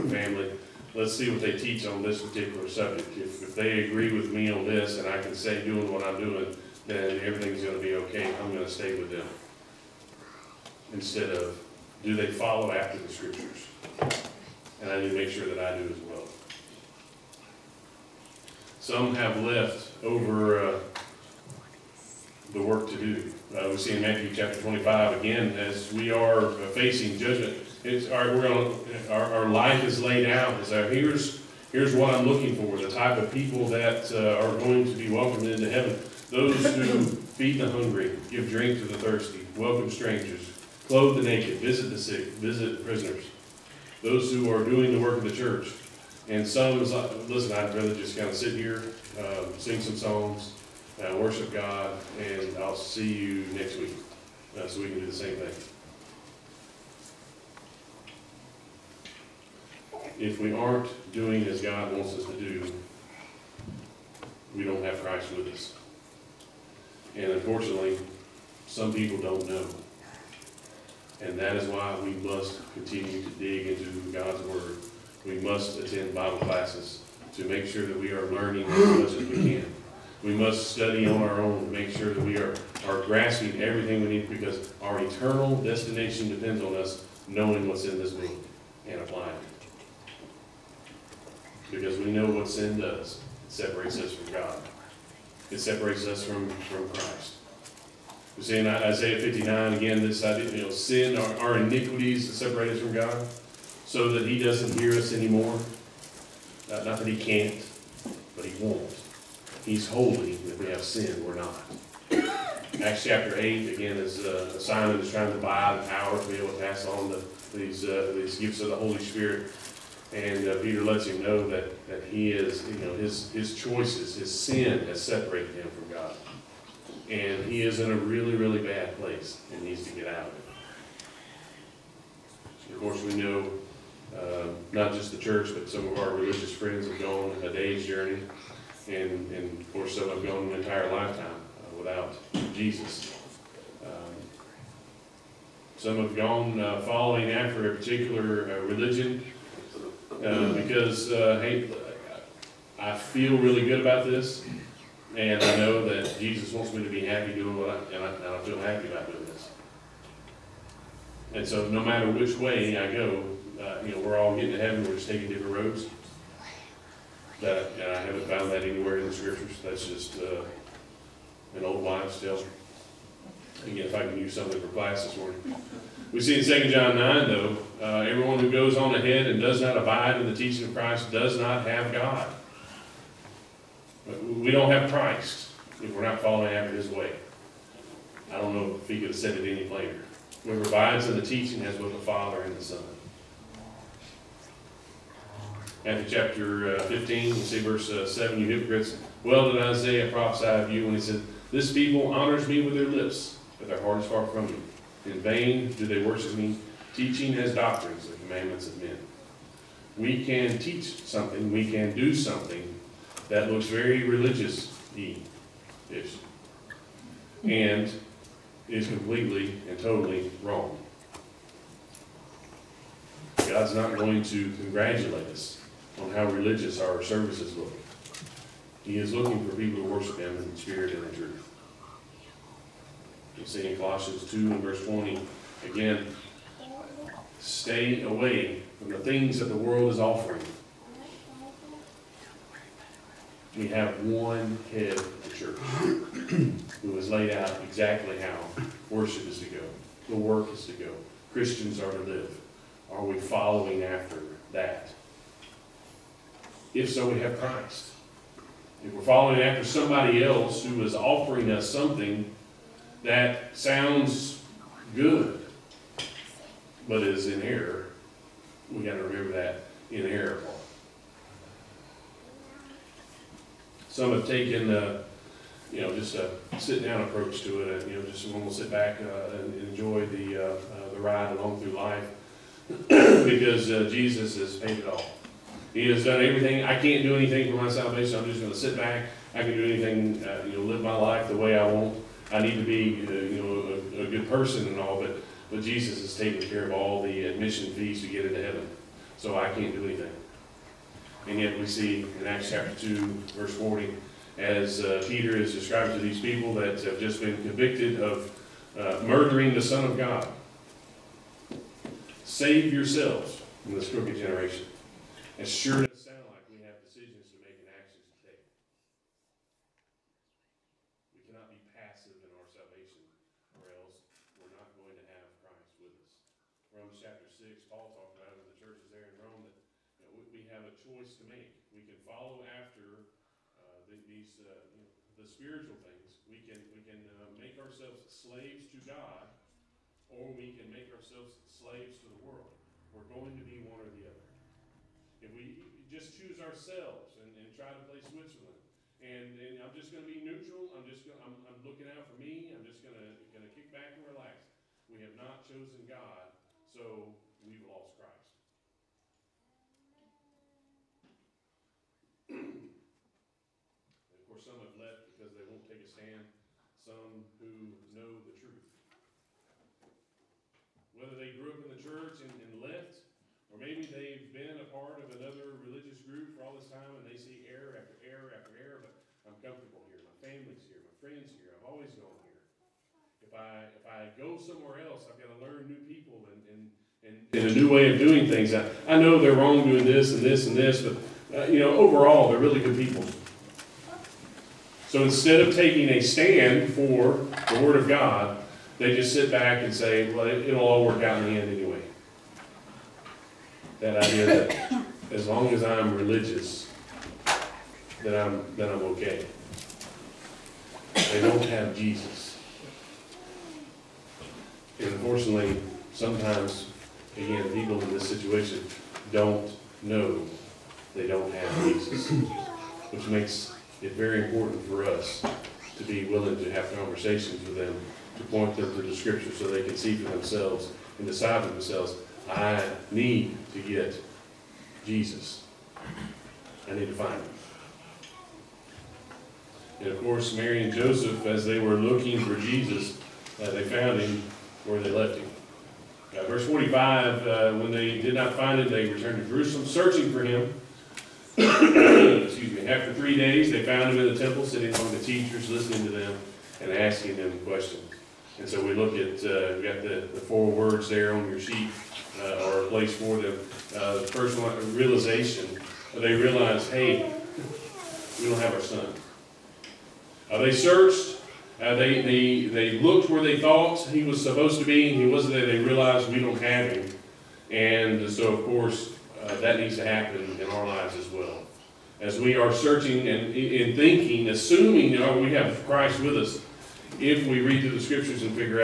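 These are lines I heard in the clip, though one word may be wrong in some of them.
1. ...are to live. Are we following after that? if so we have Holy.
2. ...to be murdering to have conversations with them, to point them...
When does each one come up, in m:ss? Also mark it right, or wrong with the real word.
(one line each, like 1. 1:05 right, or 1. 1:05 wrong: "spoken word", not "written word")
1. 4:11 wrong: "Christ", not "Holy"
2. 7:05 wrong: "willing", not "murdering".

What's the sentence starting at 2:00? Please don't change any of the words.
And uh, Peter lets him know that, that he is, you know, his, his choices, his sin has separated him from God.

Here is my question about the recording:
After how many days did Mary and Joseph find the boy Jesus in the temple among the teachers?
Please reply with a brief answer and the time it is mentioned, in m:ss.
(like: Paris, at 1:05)
3, at 7:32.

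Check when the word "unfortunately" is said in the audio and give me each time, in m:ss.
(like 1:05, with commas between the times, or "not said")
1:07, 6:54.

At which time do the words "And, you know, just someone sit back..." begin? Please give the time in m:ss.
4:37.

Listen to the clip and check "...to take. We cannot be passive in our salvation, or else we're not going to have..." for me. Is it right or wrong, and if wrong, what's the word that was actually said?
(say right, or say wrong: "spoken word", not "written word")
right.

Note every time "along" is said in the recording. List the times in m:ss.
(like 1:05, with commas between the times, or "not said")
4:41.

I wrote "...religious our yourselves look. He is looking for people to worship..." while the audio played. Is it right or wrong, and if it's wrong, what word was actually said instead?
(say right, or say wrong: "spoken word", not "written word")
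wrong: "services", not "yourselves".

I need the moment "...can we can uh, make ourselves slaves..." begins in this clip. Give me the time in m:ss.
5:36.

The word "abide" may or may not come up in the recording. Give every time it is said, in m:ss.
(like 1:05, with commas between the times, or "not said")
2:59, 3:10.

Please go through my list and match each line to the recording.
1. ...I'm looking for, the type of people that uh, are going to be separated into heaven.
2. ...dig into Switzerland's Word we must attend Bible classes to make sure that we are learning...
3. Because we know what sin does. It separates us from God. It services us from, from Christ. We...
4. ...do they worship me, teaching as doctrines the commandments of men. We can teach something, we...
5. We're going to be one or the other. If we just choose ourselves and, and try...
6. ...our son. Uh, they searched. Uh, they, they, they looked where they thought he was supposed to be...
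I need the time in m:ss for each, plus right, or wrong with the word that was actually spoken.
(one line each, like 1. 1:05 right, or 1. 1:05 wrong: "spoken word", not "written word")
1. 0:32 wrong: "welcomed", not "separated"
2. 1:13 wrong: "God", not "Switzerland"
3. 1:31 wrong: "separates", not "services"
4. 3:25 right
5. 5:42 right
6. 7:48 right.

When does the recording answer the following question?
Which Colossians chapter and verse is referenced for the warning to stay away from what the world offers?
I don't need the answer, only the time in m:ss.
3:53.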